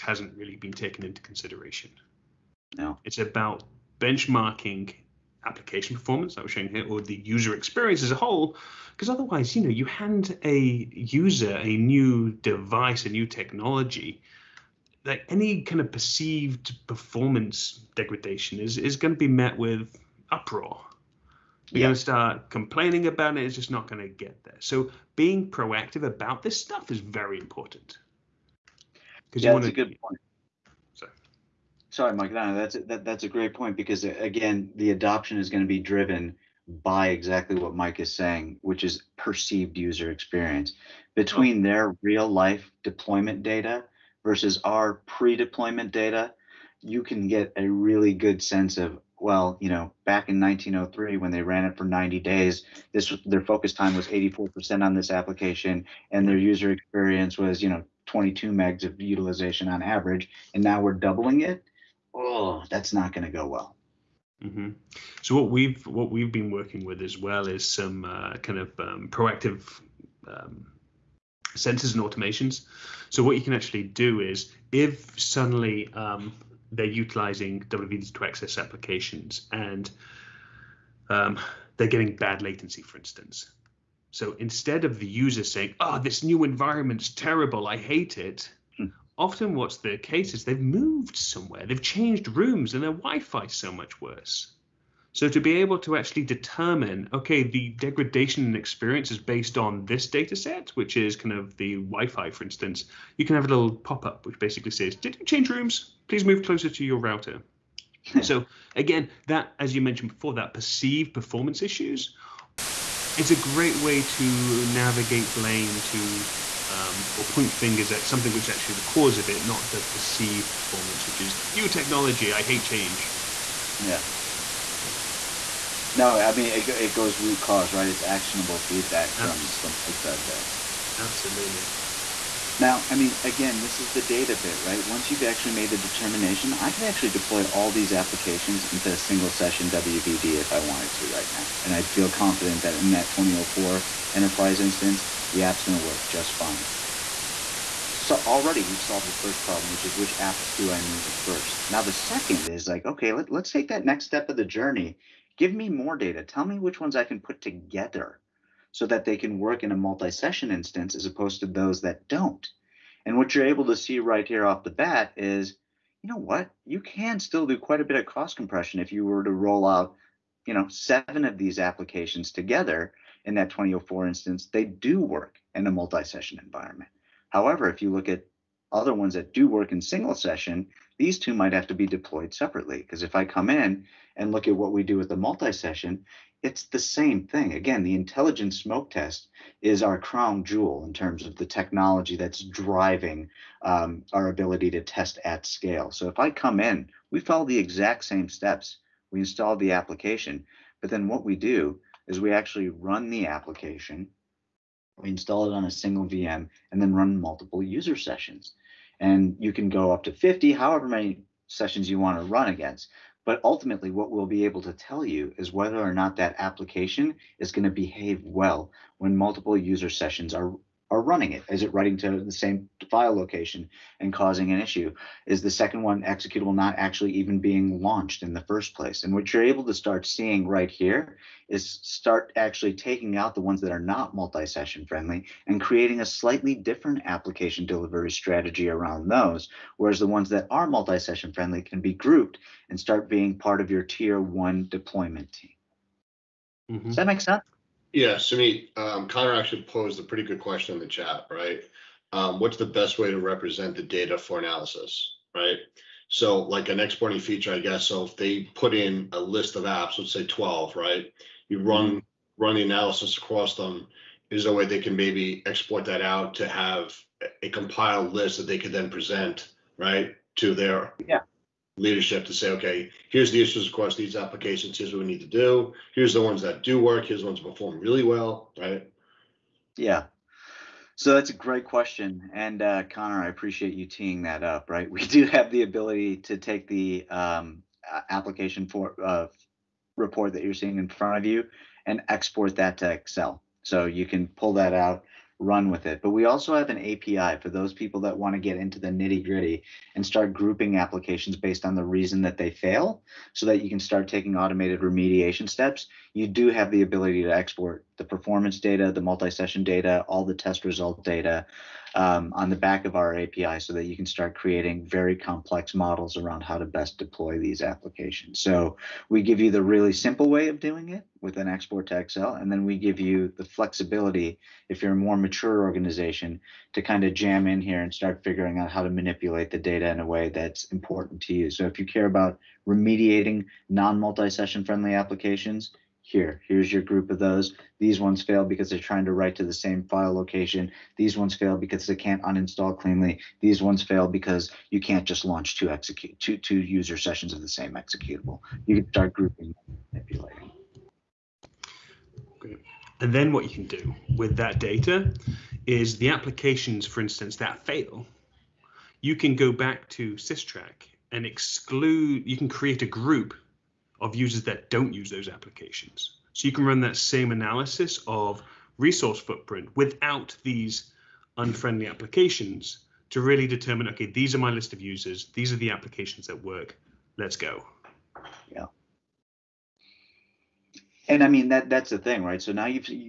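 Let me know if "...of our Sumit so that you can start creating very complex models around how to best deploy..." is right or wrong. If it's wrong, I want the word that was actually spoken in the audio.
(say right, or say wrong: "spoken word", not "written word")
wrong: "API", not "Sumit".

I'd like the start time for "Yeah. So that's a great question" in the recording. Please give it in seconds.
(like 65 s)
279 s.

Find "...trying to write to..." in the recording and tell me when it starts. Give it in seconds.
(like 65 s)
338 s.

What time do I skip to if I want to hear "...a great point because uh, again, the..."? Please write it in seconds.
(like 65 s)
33 s.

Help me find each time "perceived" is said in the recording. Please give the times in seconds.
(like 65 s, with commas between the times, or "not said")
15 s, 39 s, 110 s, 119 s.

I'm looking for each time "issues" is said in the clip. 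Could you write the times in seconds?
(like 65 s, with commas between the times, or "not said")
111 s, 224 s, 273 s.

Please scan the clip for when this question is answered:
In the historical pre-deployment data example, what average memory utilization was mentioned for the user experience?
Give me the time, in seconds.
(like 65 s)
58 s.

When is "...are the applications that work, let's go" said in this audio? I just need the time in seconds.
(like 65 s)
375 s.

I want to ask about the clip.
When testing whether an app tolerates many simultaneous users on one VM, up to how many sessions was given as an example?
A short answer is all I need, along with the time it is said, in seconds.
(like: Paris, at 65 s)
50, at 210 s.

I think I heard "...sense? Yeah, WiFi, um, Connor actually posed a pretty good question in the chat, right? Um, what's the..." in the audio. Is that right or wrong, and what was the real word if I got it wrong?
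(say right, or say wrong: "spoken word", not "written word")
wrong: "Sumit", not "WiFi".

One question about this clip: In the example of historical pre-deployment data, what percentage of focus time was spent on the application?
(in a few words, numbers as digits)
84%.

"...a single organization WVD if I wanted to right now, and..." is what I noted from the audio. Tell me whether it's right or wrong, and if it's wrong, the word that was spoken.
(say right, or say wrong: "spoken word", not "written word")
wrong: "session", not "organization".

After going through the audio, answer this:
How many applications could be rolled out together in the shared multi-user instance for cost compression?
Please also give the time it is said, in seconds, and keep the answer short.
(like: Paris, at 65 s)
7, at 170 s.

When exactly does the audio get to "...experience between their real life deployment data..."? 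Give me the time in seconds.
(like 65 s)
40 s.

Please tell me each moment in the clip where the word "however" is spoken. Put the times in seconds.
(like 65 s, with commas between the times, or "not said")
177 s, 210 s.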